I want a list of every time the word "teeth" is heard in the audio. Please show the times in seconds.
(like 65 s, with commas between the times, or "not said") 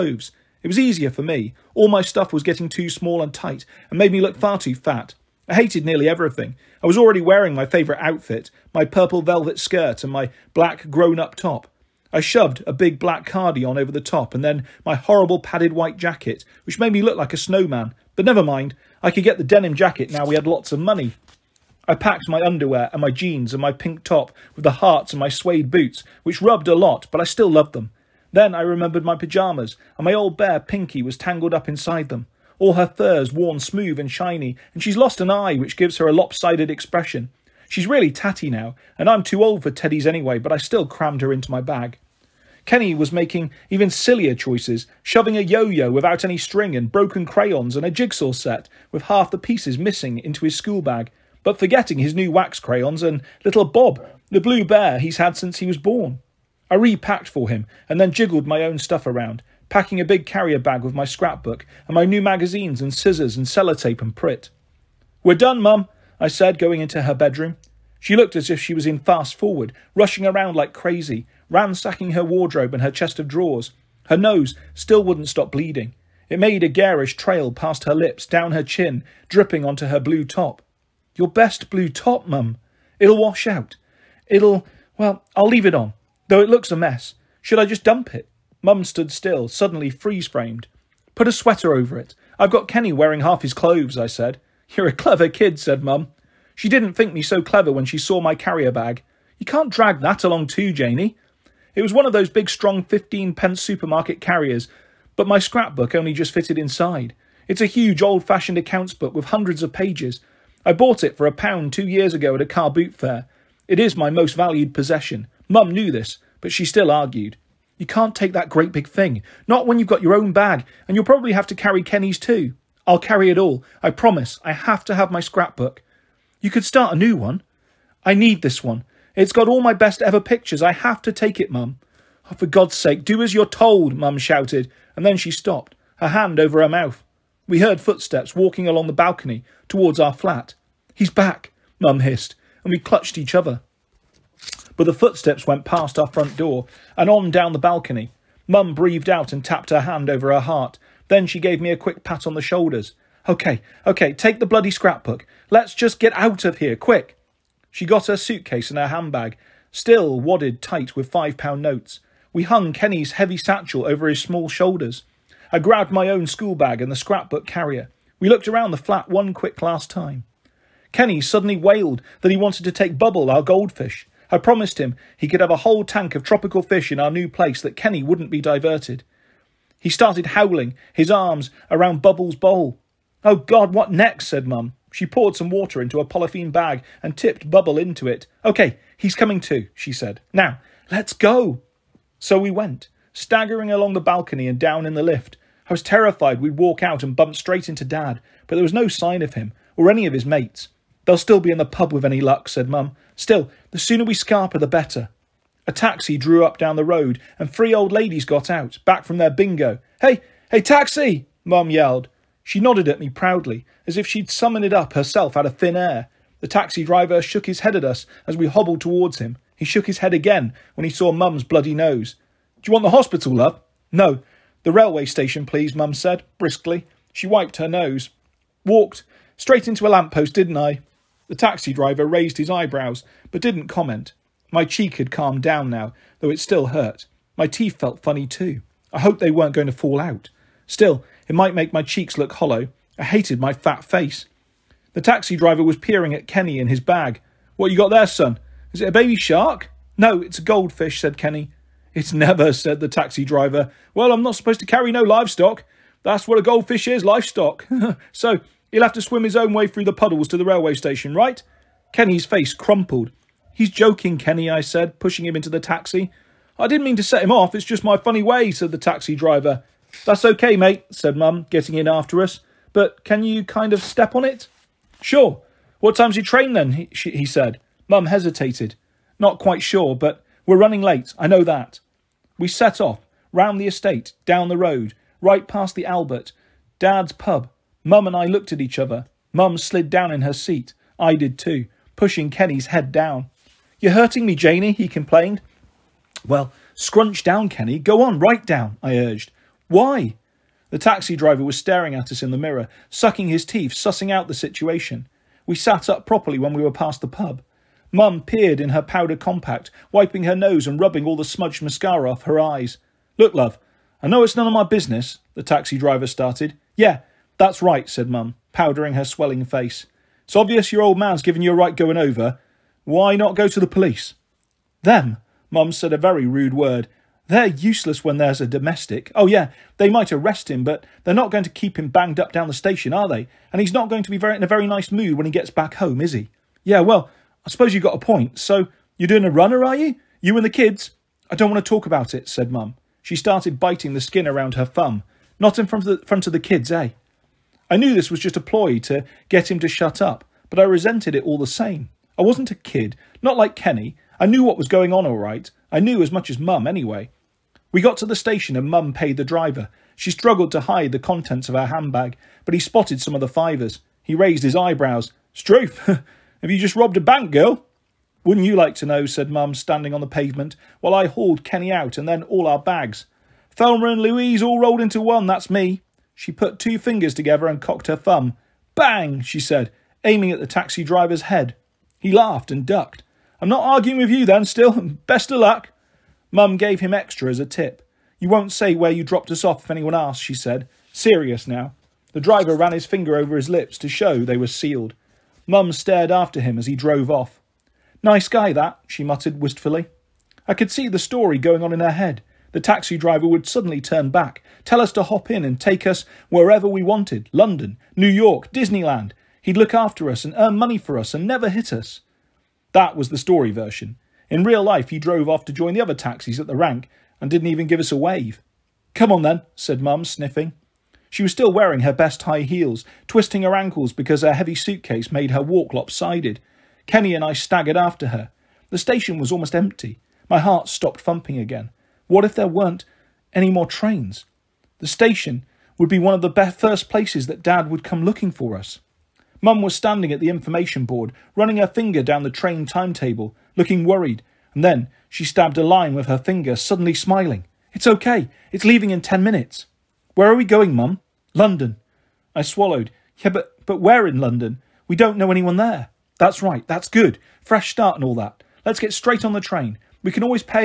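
237 s, 303 s.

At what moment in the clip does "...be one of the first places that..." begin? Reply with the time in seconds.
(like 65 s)
435 s.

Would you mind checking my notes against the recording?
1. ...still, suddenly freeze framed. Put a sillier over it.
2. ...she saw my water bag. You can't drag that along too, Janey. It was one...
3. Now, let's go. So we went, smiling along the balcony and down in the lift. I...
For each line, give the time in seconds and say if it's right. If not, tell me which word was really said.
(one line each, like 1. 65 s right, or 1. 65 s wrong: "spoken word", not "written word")
1. 89 s wrong: "sweater", not "sillier"
2. 97 s wrong: "carrier", not "water"
3. 190 s wrong: "staggering", not "smiling".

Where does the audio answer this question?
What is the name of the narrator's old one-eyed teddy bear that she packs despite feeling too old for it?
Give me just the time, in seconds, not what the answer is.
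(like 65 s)
30 s.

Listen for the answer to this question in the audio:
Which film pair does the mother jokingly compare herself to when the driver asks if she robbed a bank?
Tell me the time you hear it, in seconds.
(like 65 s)
373 s.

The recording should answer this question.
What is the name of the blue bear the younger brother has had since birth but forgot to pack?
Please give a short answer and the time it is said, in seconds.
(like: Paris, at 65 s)
Bob, at 53 s.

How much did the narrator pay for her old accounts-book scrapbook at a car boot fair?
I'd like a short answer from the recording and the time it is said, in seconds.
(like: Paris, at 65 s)
a pound, at 111 s.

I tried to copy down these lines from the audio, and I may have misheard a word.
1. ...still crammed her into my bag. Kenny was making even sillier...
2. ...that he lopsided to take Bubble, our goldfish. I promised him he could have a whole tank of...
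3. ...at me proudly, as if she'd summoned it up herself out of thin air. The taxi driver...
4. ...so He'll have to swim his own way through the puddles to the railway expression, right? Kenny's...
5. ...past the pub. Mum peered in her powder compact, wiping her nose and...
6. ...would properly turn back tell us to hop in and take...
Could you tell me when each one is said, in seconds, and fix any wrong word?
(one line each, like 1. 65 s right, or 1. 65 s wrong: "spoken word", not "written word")
1. 40 s right
2. 172 s wrong: "wanted", not "lopsided"
3. 212 s right
4. 258 s wrong: "station", not "expression"
5. 306 s right
6. 403 s wrong: "suddenly", not "properly".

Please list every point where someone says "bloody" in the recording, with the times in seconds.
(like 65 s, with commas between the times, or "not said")
154 s, 221 s.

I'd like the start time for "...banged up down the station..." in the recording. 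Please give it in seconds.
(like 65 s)
331 s.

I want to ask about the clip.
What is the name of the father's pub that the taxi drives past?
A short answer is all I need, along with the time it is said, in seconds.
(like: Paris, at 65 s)
the Albert, at 285 s.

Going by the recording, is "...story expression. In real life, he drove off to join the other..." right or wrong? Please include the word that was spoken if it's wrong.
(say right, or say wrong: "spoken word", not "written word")
wrong: "version", not "expression".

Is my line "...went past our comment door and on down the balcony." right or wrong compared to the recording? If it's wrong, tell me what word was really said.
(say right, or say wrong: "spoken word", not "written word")
wrong: "front", not "comment".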